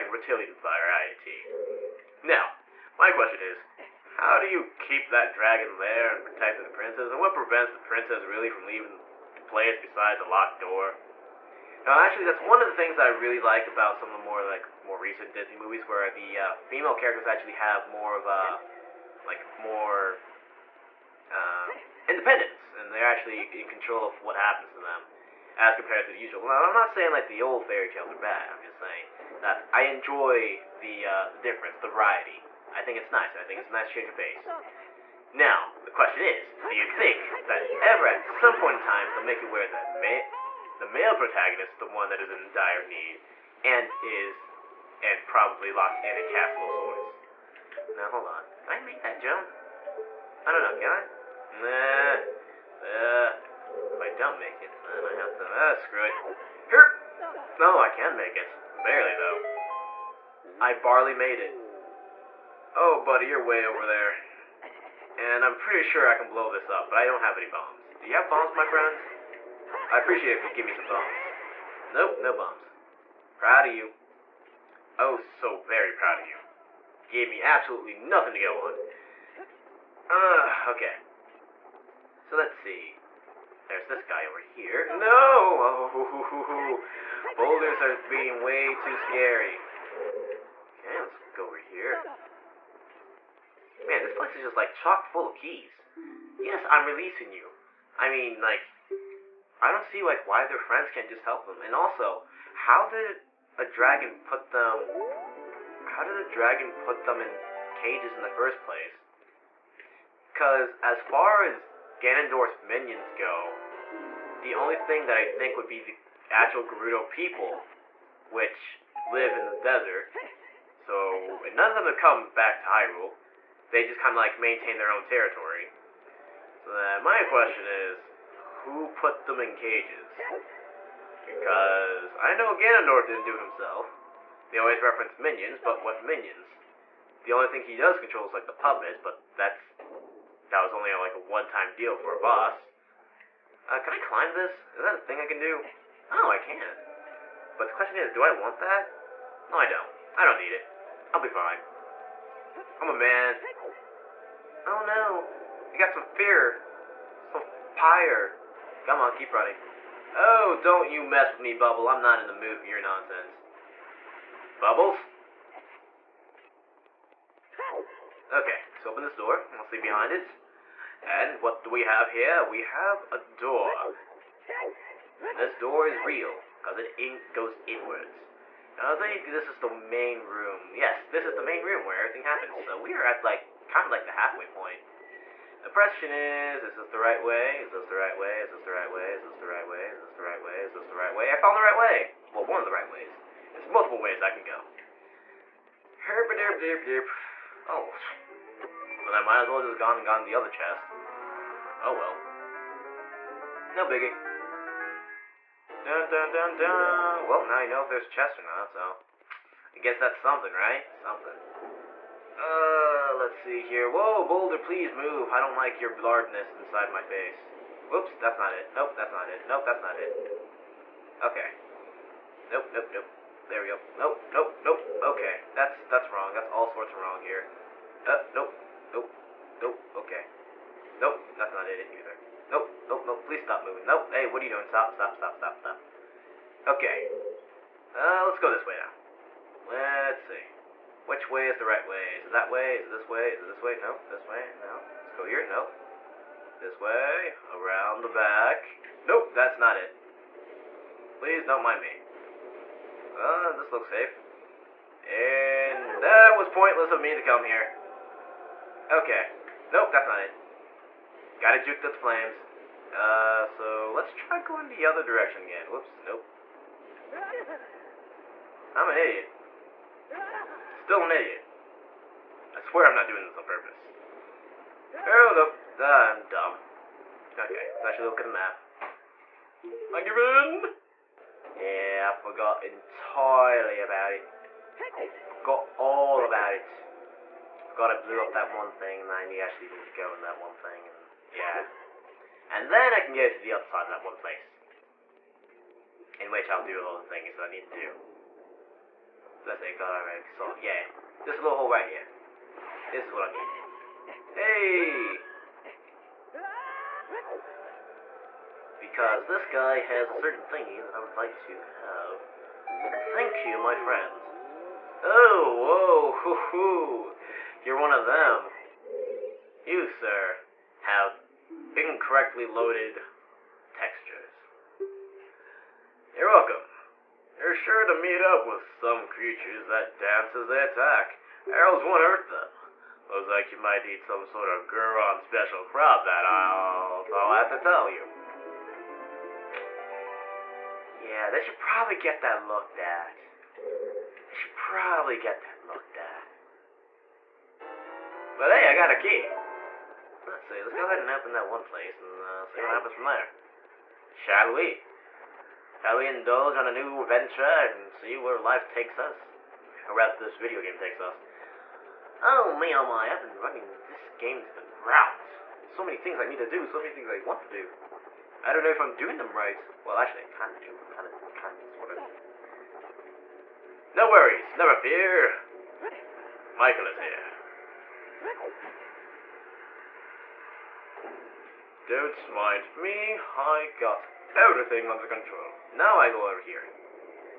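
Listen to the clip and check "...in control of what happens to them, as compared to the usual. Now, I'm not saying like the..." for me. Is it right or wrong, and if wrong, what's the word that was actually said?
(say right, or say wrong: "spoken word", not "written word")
right.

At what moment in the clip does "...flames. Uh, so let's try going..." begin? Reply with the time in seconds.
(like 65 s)
261 s.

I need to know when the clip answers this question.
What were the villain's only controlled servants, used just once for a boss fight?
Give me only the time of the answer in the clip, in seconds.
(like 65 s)
138 s.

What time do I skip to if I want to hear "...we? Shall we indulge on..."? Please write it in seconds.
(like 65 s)
354 s.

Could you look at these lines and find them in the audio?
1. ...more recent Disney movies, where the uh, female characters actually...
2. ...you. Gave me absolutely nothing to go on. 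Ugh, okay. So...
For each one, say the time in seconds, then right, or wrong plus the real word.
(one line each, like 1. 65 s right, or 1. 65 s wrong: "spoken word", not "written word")
1. 14 s right
2. 76 s right.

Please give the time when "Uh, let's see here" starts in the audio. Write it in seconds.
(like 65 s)
212 s.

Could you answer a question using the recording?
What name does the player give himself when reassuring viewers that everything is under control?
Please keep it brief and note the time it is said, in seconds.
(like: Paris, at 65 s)
Michael, at 376 s.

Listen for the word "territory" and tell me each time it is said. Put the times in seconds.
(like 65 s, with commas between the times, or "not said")
125 s.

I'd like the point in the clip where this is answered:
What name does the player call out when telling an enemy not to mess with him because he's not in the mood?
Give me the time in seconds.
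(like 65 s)
161 s.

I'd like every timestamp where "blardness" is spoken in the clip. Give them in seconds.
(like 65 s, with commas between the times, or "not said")
215 s.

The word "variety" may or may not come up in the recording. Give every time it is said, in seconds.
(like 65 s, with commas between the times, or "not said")
0 s, 31 s.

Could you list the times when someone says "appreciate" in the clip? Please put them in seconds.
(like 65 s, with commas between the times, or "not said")
69 s.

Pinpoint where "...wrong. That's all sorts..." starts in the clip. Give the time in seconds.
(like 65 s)
226 s.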